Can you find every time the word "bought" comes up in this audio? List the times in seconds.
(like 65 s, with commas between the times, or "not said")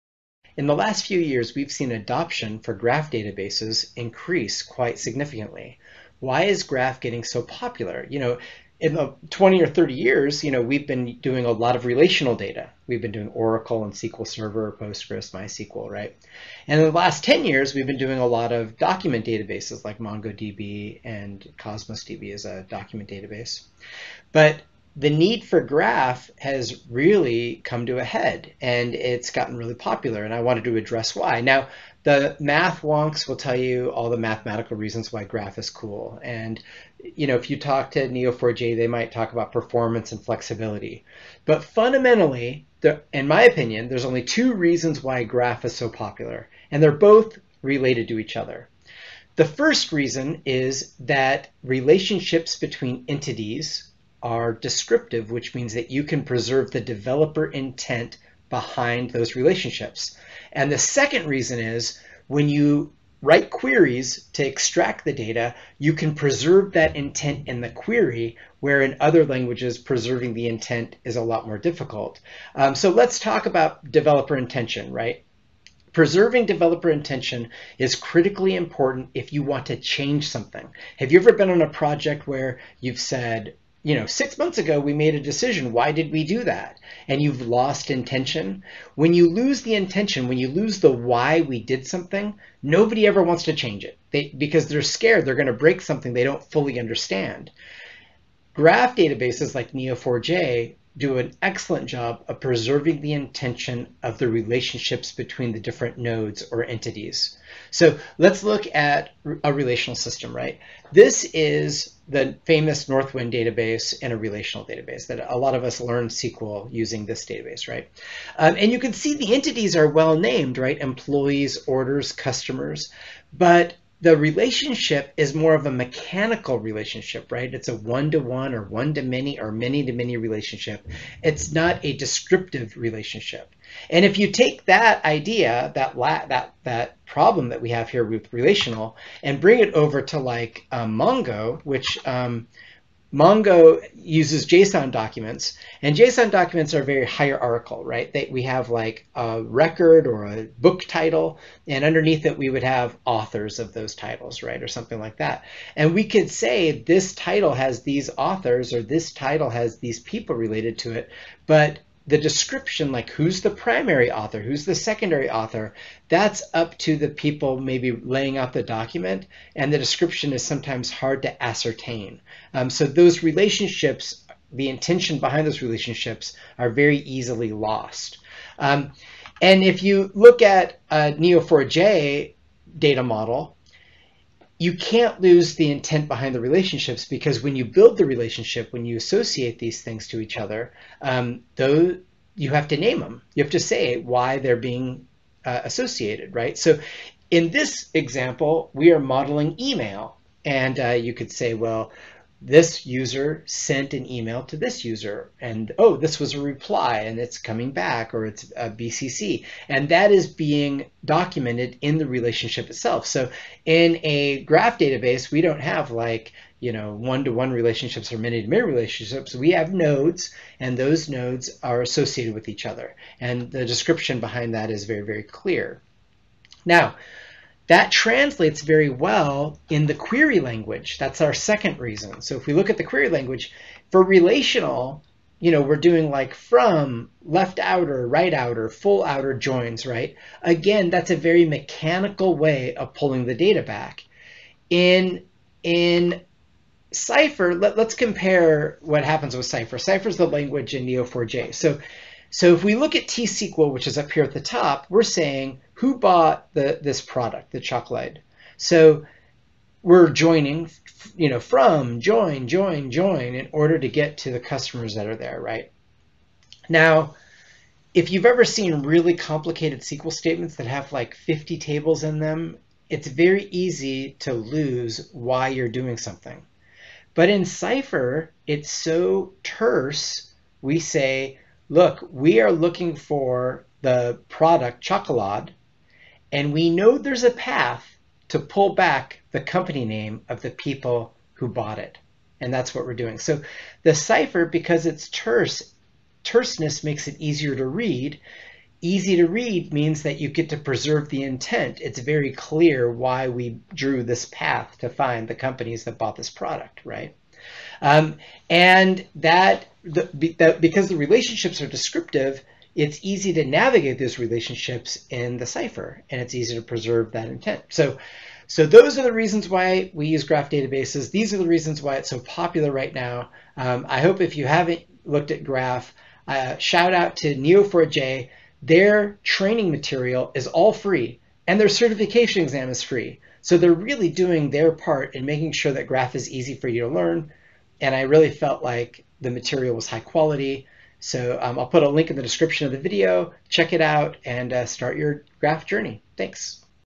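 255 s, 291 s, 305 s.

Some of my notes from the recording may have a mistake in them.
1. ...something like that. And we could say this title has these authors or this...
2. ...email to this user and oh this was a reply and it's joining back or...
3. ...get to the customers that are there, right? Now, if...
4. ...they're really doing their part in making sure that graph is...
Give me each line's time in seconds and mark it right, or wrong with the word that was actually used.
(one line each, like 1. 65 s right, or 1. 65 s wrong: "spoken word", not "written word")
1. 154 s right
2. 204 s wrong: "coming", not "joining"
3. 263 s right
4. 333 s right.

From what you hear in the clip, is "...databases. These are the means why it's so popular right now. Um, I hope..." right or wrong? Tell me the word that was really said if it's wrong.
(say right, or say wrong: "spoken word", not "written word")
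wrong: "reasons", not "means".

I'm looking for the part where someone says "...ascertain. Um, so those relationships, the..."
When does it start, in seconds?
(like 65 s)
171 s.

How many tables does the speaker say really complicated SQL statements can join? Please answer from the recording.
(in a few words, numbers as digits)
50.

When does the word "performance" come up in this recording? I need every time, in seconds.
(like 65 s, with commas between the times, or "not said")
39 s.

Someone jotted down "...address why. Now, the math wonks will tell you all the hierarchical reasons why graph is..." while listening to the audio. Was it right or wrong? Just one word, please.
wrong.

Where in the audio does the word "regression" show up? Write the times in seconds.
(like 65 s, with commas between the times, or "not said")
not said.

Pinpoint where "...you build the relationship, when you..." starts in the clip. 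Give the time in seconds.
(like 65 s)
187 s.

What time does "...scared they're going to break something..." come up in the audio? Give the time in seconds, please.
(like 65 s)
94 s.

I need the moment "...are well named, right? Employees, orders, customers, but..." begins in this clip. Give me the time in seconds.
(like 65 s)
119 s.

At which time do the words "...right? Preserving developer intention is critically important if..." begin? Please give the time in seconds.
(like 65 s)
74 s.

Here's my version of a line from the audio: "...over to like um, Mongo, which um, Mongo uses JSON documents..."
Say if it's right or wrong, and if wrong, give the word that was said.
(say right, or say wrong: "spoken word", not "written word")
right.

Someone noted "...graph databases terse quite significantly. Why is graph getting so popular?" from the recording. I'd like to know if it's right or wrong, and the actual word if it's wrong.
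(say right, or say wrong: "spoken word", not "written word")
wrong: "increase", not "terse".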